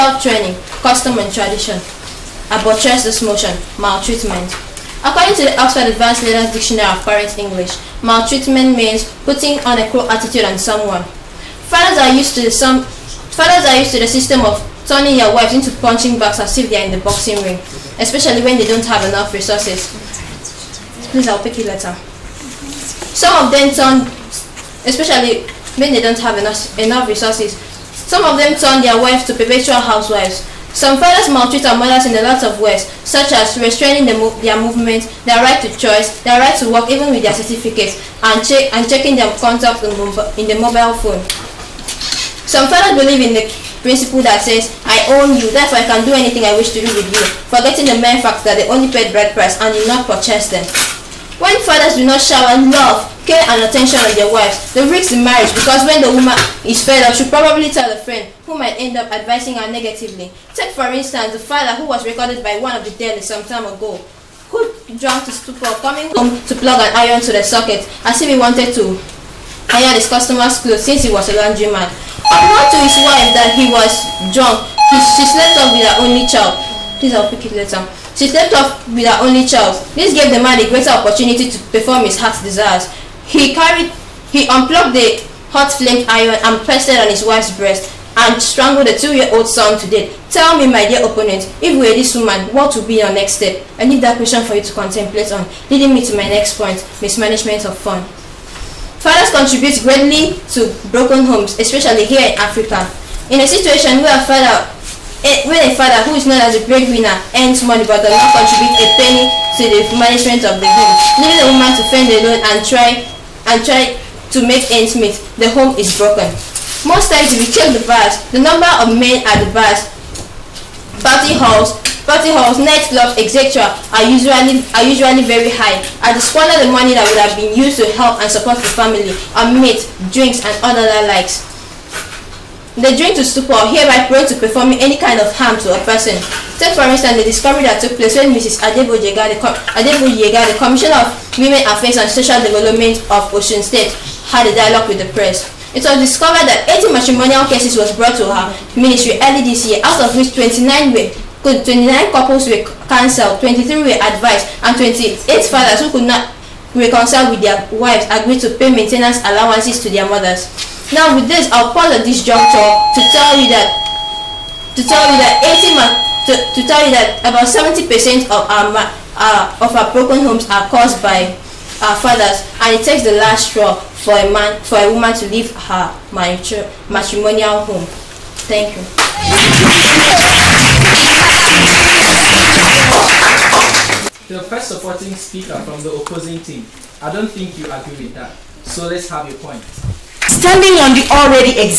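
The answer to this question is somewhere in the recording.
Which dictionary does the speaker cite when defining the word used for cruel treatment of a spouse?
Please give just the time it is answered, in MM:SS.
00:05.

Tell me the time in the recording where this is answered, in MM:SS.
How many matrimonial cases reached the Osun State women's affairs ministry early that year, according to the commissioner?
02:26.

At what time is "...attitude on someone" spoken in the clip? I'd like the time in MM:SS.
00:10.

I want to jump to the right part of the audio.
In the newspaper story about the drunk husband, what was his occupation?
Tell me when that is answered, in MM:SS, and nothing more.
01:11.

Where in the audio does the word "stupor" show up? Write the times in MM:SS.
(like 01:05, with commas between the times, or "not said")
01:05, 02:13.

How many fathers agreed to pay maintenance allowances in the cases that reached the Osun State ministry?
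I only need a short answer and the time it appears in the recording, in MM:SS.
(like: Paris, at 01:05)
28, at 02:34.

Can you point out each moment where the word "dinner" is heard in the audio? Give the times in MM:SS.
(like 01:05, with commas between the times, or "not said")
not said.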